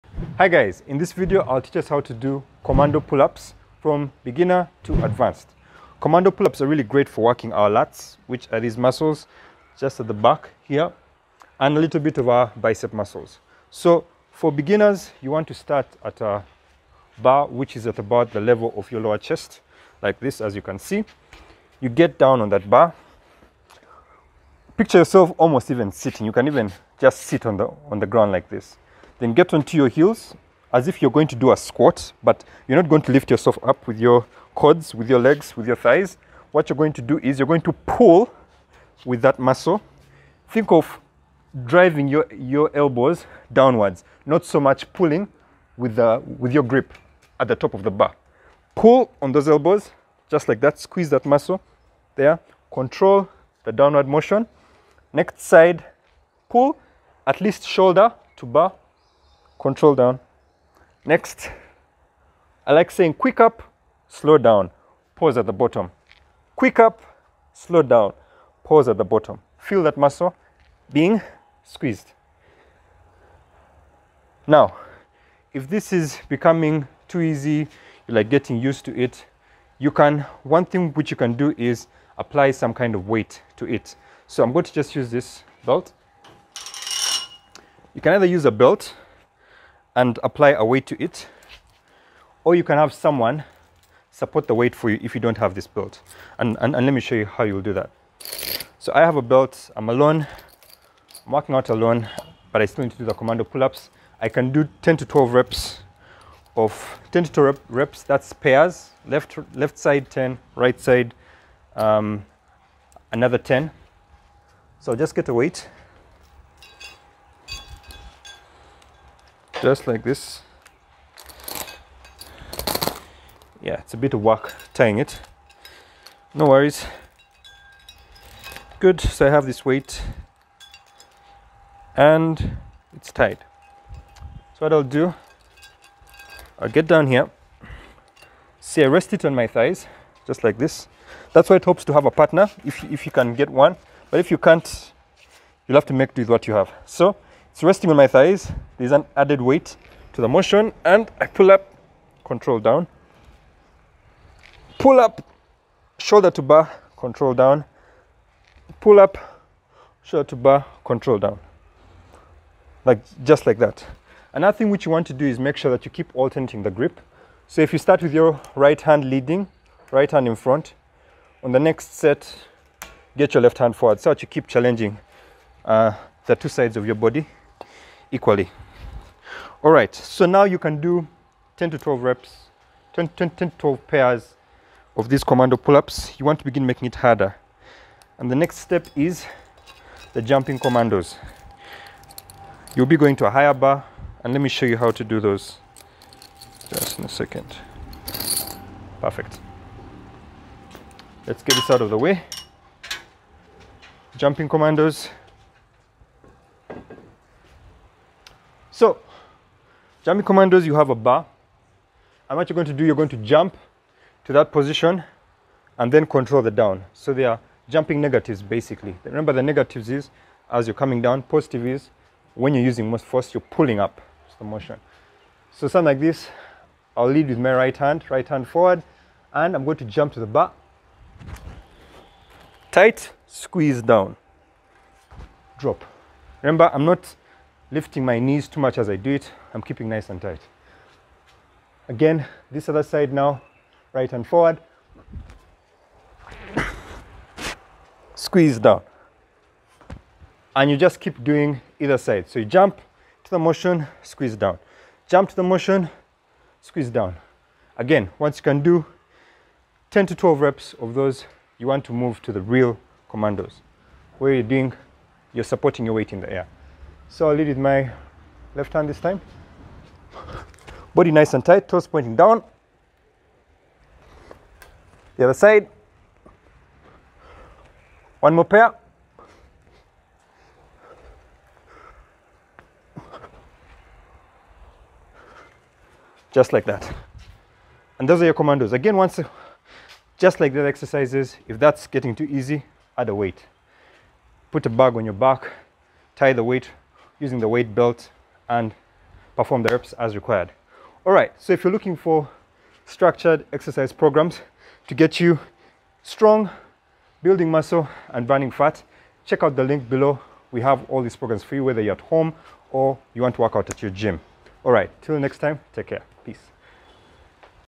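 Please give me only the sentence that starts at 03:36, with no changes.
So they are jumping negatives basically.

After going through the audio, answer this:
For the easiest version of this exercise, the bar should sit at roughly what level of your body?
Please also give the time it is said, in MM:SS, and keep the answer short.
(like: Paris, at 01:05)
lower chest, at 00:19.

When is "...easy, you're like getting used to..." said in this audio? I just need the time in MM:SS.
01:17.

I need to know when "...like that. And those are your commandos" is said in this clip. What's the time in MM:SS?
04:46.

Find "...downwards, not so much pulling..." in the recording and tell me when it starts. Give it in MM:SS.
00:43.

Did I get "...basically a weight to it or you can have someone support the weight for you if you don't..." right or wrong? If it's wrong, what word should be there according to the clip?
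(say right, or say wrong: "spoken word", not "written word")
wrong: "apply", not "basically".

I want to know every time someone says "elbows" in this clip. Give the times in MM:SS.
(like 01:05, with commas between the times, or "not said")
00:42, 00:49.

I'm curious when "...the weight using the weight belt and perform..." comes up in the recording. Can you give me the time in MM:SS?
04:56.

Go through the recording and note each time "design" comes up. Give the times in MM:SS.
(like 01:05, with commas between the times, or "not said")
not said.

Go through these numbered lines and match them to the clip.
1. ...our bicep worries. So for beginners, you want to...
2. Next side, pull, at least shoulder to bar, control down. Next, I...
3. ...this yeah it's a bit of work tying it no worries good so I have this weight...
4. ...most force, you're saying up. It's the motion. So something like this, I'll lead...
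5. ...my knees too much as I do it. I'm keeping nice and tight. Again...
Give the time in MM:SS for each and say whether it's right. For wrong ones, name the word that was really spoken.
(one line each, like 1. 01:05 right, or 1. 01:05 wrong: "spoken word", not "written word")
1. 00:12 wrong: "muscles", not "worries"
2. 00:55 right
3. 02:00 right
4. 03:42 wrong: "pulling", not "saying"
5. 03:58 right.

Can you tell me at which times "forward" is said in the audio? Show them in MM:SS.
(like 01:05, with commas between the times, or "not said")
02:53, 03:48, 04:04.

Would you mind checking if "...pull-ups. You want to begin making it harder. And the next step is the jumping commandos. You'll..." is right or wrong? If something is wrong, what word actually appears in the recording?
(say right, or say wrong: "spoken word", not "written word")
right.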